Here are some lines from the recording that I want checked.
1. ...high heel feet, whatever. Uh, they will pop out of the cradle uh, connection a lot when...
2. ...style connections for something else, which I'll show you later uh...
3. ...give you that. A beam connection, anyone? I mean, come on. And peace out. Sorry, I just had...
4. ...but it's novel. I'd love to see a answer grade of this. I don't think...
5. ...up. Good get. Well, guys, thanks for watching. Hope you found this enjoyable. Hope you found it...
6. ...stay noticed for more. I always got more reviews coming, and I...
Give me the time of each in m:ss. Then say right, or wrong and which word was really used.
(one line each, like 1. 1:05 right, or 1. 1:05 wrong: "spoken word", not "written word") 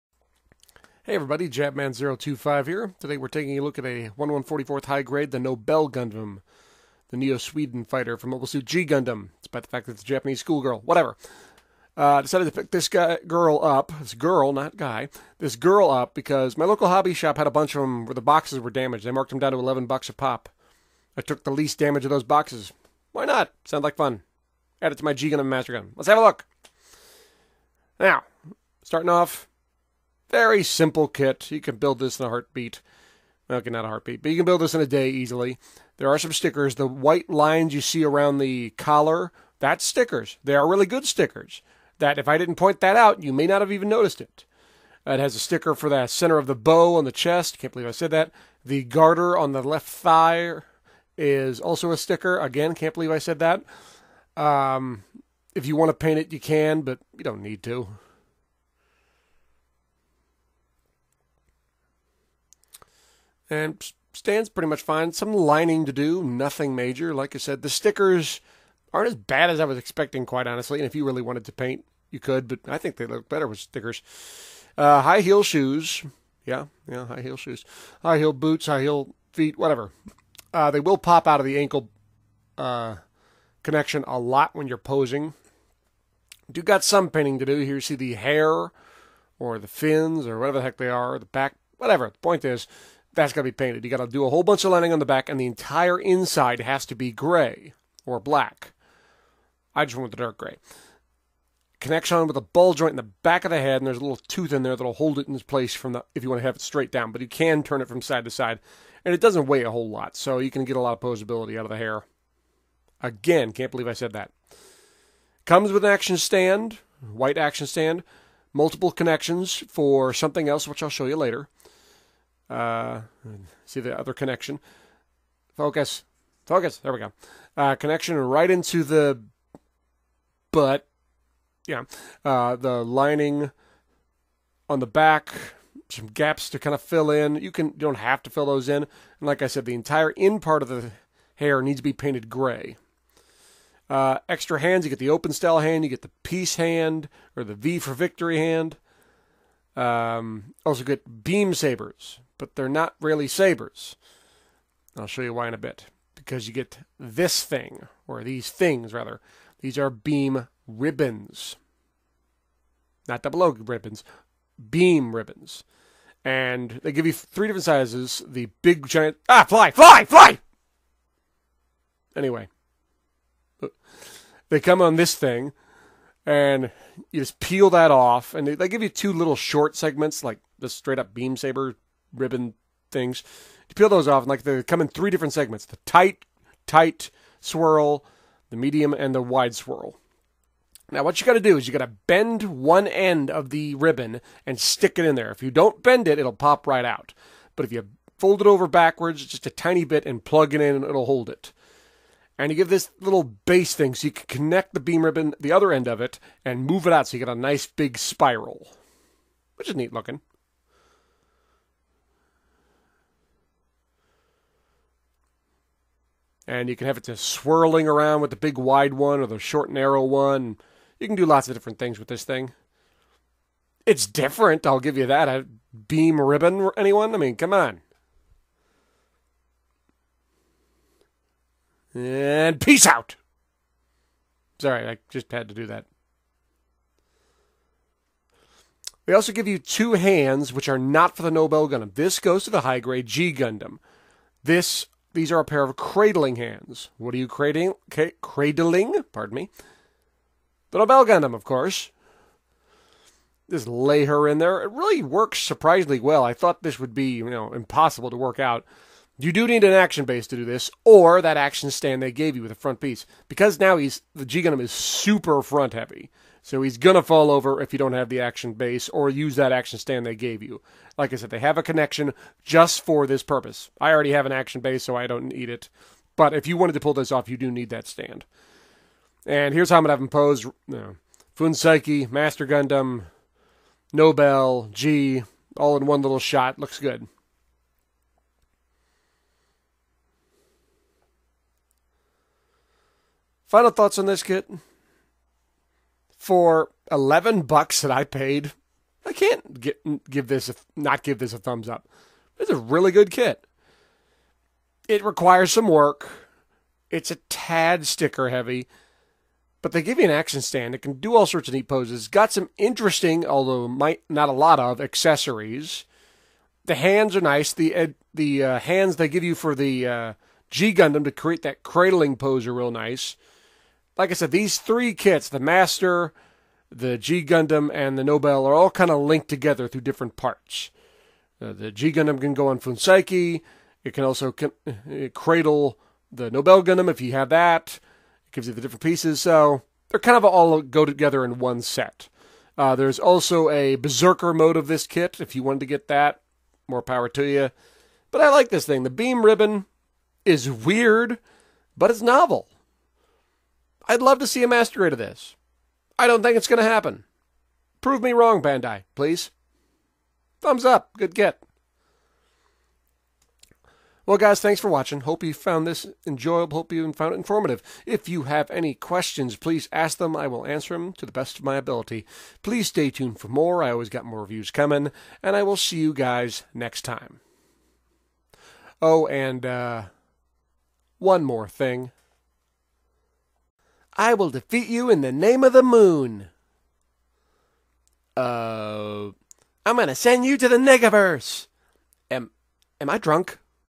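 1. 1:18 wrong: "ankle", not "cradle"
2. 1:58 wrong: "multiple", not "style"
3. 3:44 wrong: "ribbon", not "connection"
4. 5:51 wrong: "master", not "answer"
5. 6:00 right
6. 6:12 wrong: "tuned", not "noticed".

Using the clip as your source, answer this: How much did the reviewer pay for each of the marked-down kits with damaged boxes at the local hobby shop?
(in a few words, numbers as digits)
$11.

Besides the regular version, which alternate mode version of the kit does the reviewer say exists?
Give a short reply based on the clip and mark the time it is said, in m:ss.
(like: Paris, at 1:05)
Berserker mode, at 5:43.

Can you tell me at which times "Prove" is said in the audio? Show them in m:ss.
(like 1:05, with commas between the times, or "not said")
5:57.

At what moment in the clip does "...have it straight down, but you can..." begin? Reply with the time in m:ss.
1:46.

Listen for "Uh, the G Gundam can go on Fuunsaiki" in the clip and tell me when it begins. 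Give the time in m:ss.
5:31.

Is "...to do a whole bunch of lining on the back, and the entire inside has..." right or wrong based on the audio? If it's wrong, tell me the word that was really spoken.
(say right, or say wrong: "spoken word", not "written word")
right.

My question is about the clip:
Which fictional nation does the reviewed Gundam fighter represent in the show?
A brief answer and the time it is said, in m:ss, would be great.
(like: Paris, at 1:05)
Neo Sweden, at 0:07.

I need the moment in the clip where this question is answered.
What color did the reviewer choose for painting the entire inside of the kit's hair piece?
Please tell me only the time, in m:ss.
1:40.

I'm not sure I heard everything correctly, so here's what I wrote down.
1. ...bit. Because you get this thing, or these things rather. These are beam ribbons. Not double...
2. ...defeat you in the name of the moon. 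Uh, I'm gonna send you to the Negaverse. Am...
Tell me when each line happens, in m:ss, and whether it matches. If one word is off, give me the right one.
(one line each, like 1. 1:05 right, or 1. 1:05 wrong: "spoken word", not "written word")
1. 2:35 right
2. 6:24 right.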